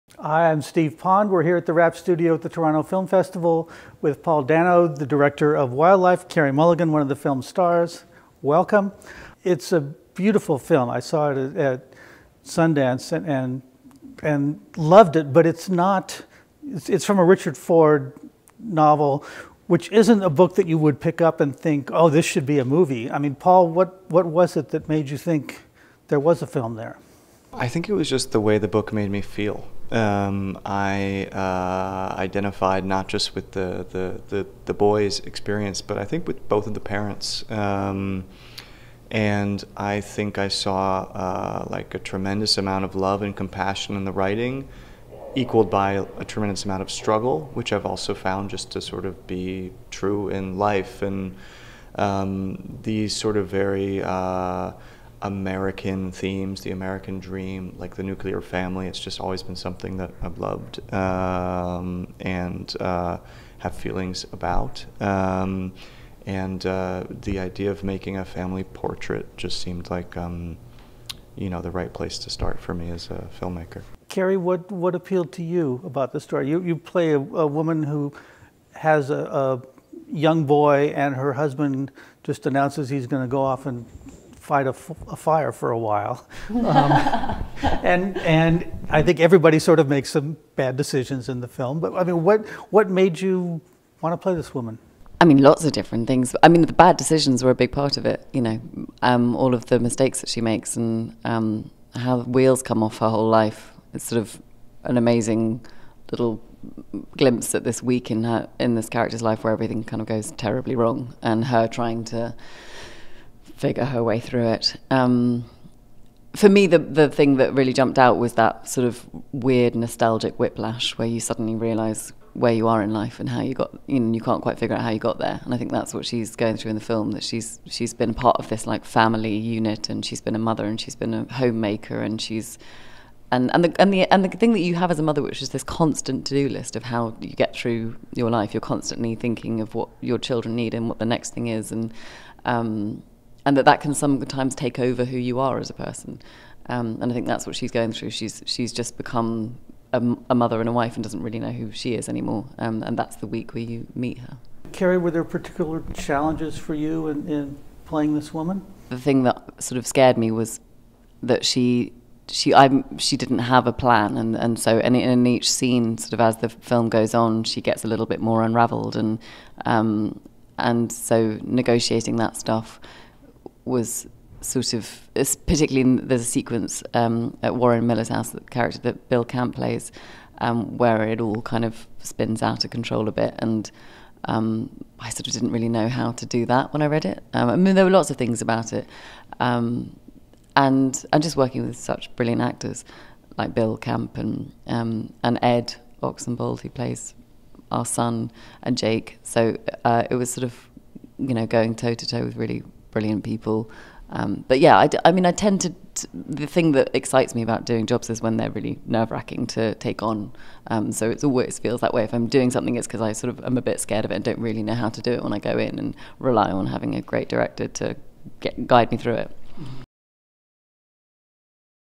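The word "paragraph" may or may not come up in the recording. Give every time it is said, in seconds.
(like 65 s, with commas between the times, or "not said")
not said.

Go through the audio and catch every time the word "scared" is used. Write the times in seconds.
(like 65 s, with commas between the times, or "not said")
159 s, 213 s.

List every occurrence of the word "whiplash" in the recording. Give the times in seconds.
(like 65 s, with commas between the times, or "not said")
120 s.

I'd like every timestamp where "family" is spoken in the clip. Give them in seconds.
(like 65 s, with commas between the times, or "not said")
58 s, 68 s, 128 s.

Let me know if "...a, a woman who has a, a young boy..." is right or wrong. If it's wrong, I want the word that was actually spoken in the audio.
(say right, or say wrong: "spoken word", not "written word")
right.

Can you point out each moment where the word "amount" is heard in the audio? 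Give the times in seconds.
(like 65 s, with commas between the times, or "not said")
42 s, 46 s.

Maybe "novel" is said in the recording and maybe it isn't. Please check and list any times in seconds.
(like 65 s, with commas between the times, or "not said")
18 s.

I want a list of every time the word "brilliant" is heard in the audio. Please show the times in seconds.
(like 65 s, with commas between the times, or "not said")
192 s, 202 s.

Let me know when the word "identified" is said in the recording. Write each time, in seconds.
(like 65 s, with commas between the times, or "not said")
32 s.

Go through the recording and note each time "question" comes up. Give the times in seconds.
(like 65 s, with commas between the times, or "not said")
not said.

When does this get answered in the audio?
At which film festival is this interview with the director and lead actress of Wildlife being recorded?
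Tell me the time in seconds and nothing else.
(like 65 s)
2 s.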